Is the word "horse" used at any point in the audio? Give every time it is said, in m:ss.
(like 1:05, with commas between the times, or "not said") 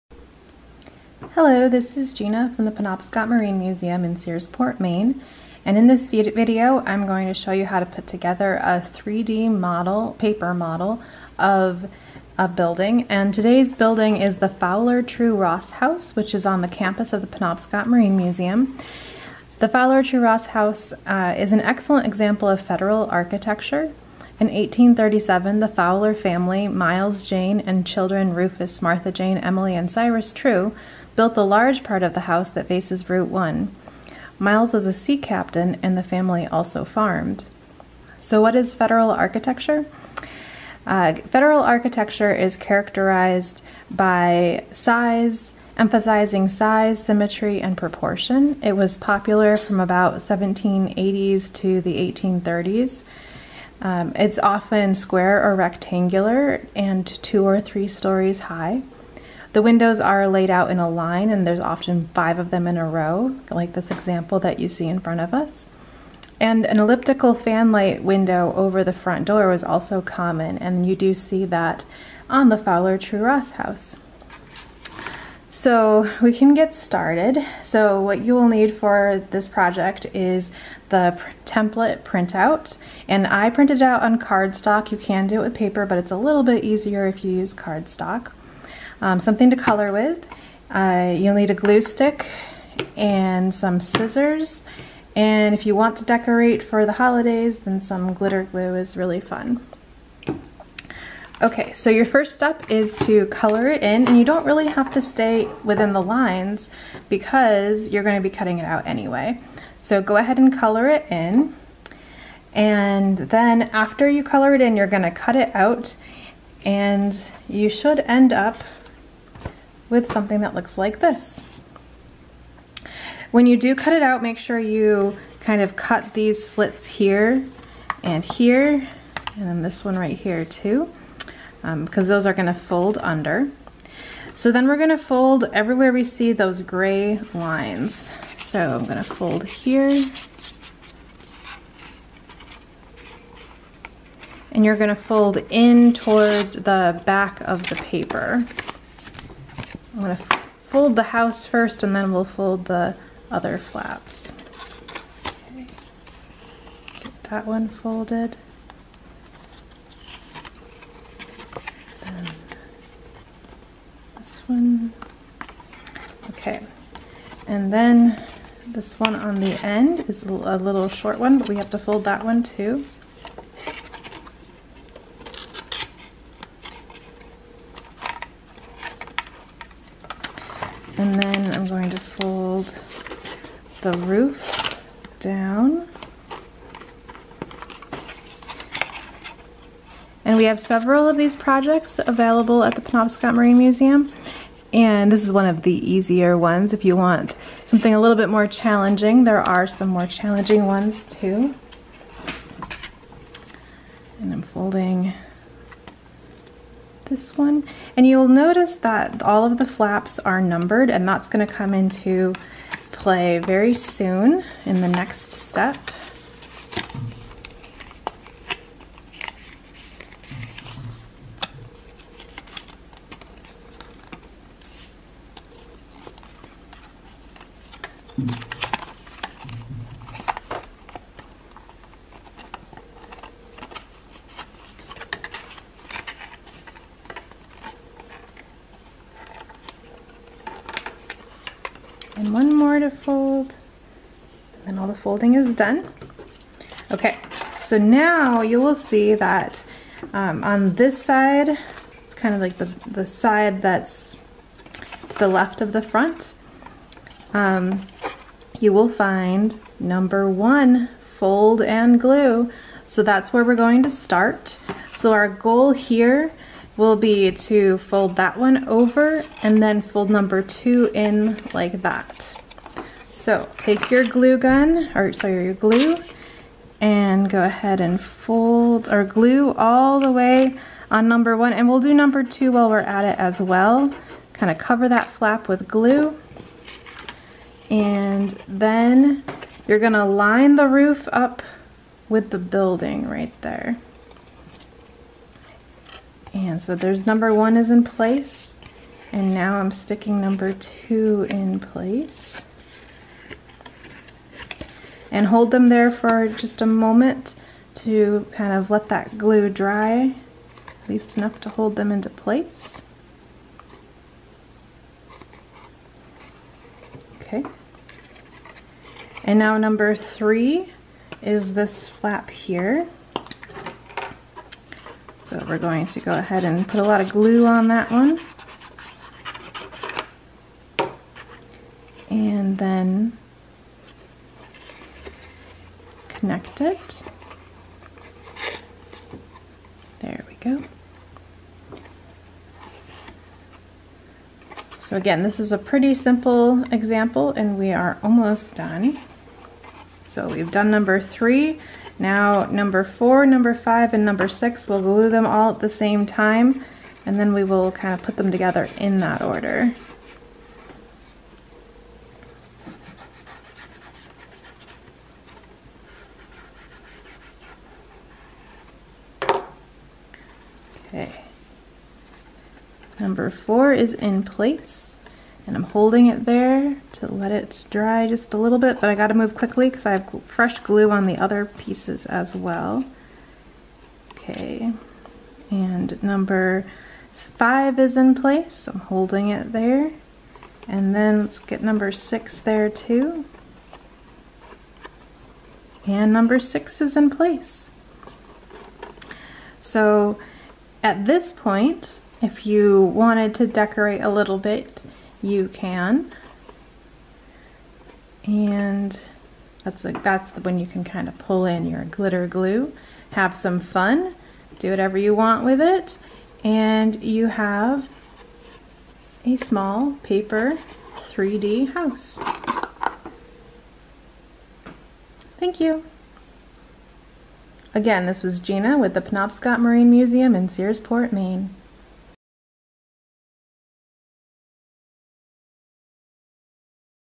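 not said.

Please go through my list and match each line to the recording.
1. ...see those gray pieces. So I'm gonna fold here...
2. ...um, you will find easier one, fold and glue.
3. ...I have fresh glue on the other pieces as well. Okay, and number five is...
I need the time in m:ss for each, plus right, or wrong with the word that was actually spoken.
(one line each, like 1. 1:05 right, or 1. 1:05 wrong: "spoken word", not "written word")
1. 2:16 wrong: "lines", not "pieces"
2. 4:17 wrong: "number", not "easier"
3. 6:19 right.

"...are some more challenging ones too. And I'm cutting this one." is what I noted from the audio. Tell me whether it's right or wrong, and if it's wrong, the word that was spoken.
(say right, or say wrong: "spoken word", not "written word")
wrong: "folding", not "cutting".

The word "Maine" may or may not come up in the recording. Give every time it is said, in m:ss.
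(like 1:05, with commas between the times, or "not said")
0:04, 7:11.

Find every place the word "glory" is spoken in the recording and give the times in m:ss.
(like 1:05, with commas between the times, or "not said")
not said.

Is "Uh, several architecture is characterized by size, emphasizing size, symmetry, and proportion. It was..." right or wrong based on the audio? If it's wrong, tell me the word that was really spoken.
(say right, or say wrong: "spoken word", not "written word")
wrong: "federal", not "several".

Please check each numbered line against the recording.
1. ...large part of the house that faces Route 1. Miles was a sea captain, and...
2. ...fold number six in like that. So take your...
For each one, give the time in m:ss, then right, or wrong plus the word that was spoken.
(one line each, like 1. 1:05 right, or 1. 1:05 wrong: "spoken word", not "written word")
1. 0:31 right
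2. 4:29 wrong: "two", not "six".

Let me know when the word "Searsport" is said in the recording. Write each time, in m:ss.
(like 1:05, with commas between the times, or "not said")
0:04, 7:10.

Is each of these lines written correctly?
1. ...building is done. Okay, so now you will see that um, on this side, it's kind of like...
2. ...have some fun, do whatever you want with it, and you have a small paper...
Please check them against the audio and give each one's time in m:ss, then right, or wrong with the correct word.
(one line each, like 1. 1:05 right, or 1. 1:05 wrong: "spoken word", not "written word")
1. 4:04 wrong: "folding", not "building"
2. 6:53 right.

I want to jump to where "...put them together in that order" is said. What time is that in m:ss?
5:58.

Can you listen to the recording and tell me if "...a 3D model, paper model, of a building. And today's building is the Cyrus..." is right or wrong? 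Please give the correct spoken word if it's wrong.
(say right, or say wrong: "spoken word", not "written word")
wrong: "Fowler", not "Cyrus".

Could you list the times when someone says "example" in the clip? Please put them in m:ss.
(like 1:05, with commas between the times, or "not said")
0:22, 1:03, 5:46.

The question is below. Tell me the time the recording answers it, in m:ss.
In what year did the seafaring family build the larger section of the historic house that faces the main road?
0:24.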